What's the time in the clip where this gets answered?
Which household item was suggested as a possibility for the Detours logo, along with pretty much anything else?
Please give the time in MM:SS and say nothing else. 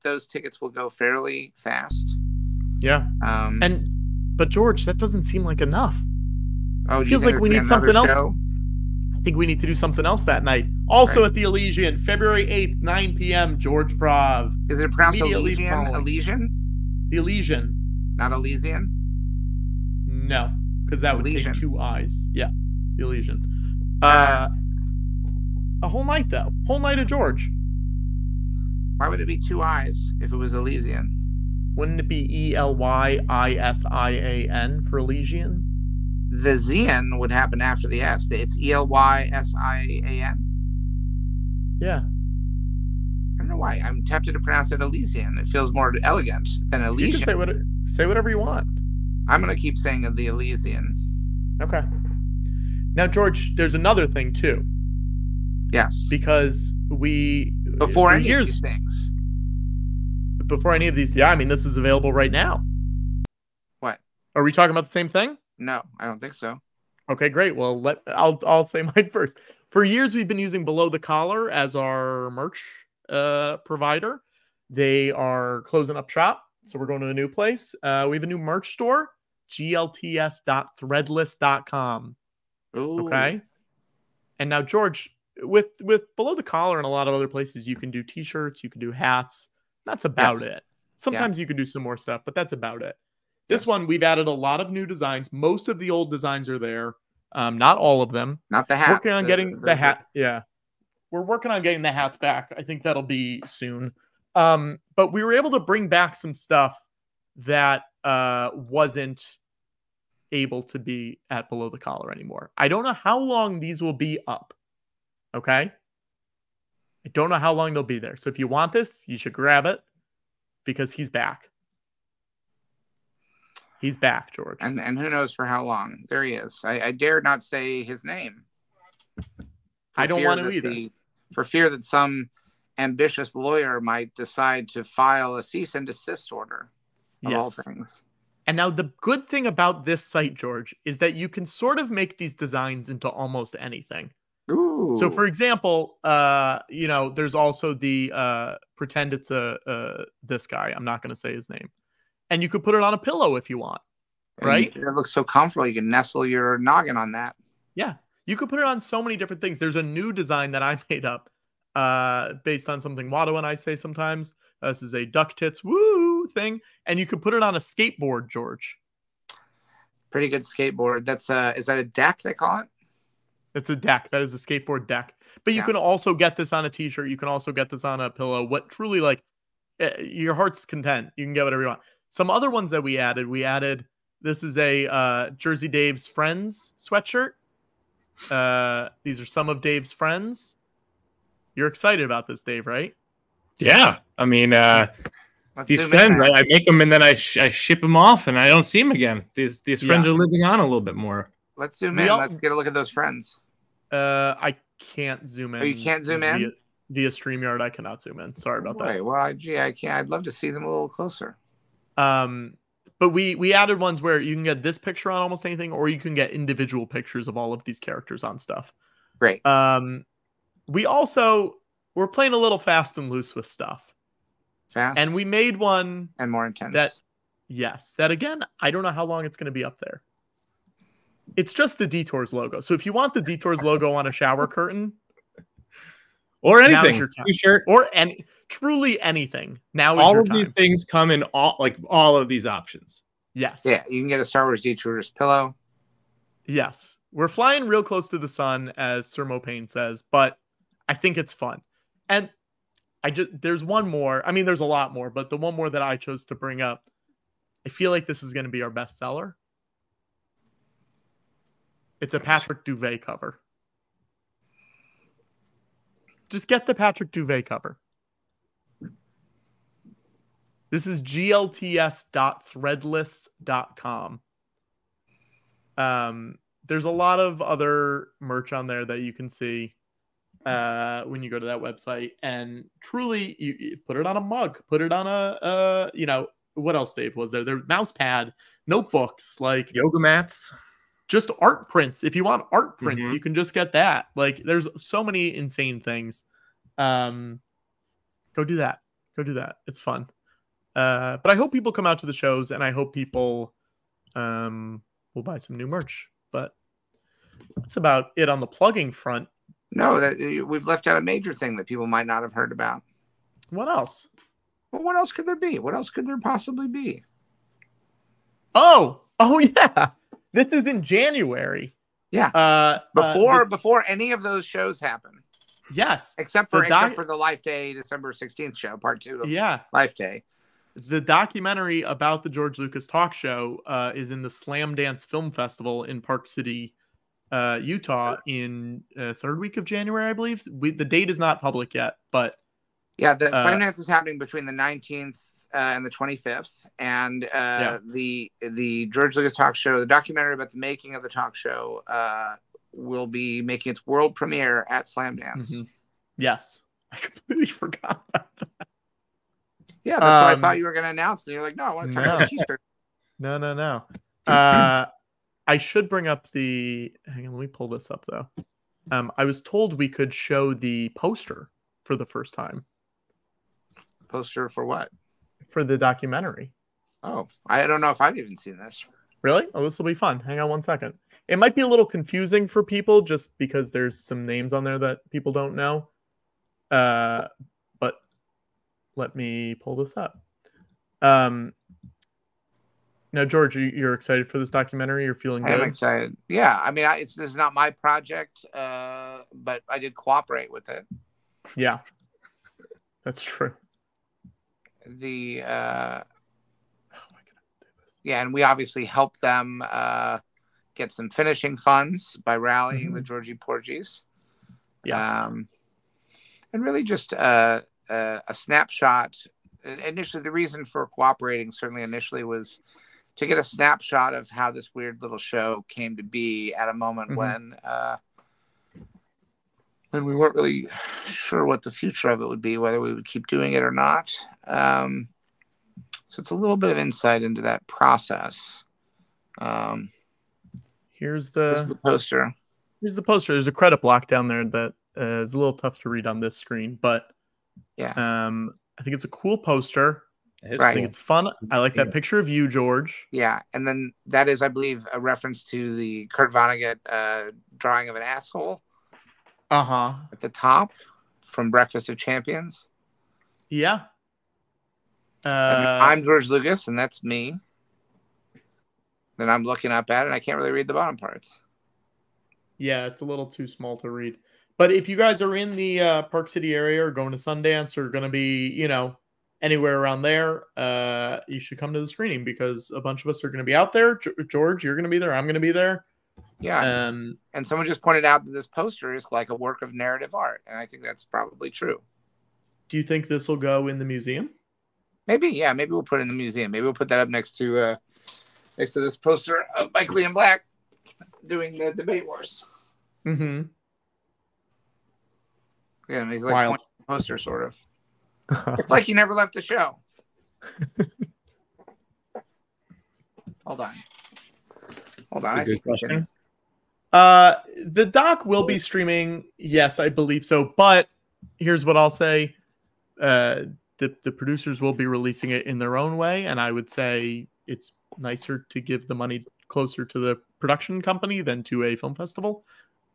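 03:54.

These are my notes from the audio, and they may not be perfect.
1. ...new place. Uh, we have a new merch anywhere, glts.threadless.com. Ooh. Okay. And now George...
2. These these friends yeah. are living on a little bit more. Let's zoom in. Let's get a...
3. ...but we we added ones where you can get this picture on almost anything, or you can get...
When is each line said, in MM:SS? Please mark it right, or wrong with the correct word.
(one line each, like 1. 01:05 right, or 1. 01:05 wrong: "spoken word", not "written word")
1. 01:17 wrong: "store", not "anywhere"
2. 03:19 right
3. 03:32 right.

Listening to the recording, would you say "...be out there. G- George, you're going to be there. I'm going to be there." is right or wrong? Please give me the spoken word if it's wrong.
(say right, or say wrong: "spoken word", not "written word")
right.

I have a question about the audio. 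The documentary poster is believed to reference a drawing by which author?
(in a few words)
Kurt Vonnegut.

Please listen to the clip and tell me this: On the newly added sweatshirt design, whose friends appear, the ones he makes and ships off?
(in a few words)
Jersey Dave.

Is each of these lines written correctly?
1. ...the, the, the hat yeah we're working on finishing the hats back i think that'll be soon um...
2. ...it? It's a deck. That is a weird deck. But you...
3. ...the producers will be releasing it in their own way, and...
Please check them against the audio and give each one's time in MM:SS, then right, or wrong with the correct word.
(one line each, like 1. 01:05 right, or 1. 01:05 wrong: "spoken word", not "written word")
1. 01:39 wrong: "getting", not "finishing"
2. 02:52 wrong: "skateboard", not "weird"
3. 08:44 right.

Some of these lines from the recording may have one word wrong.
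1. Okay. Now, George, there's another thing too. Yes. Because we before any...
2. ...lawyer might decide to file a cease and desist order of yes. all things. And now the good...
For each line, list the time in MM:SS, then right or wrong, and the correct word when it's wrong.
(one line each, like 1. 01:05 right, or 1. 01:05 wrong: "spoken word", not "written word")
1. 00:51 right
2. 02:13 right.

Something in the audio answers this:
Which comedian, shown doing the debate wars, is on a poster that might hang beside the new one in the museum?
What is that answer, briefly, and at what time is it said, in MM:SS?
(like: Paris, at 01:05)
Michael Ian Black, at 08:19.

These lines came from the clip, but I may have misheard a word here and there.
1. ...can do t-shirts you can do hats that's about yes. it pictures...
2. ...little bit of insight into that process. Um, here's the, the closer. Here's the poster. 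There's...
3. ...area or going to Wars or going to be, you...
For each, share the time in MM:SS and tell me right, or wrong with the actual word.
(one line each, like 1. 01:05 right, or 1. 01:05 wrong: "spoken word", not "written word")
1. 01:27 wrong: "sometimes", not "pictures"
2. 07:16 wrong: "poster", not "closer"
3. 07:56 wrong: "Sundance", not "Wars".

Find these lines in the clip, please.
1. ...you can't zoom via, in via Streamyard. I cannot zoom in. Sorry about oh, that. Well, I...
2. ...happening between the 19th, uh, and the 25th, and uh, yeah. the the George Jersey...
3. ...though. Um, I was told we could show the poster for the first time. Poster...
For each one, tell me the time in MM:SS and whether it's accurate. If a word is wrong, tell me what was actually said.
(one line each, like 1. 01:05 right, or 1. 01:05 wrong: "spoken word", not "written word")
1. 03:25 right
2. 05:43 wrong: "Lucas", not "Jersey"
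3. 06:08 right.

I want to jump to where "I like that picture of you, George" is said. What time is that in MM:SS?
07:31.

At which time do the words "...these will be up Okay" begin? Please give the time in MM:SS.
01:53.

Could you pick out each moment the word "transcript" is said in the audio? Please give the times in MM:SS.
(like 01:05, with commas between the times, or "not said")
not said.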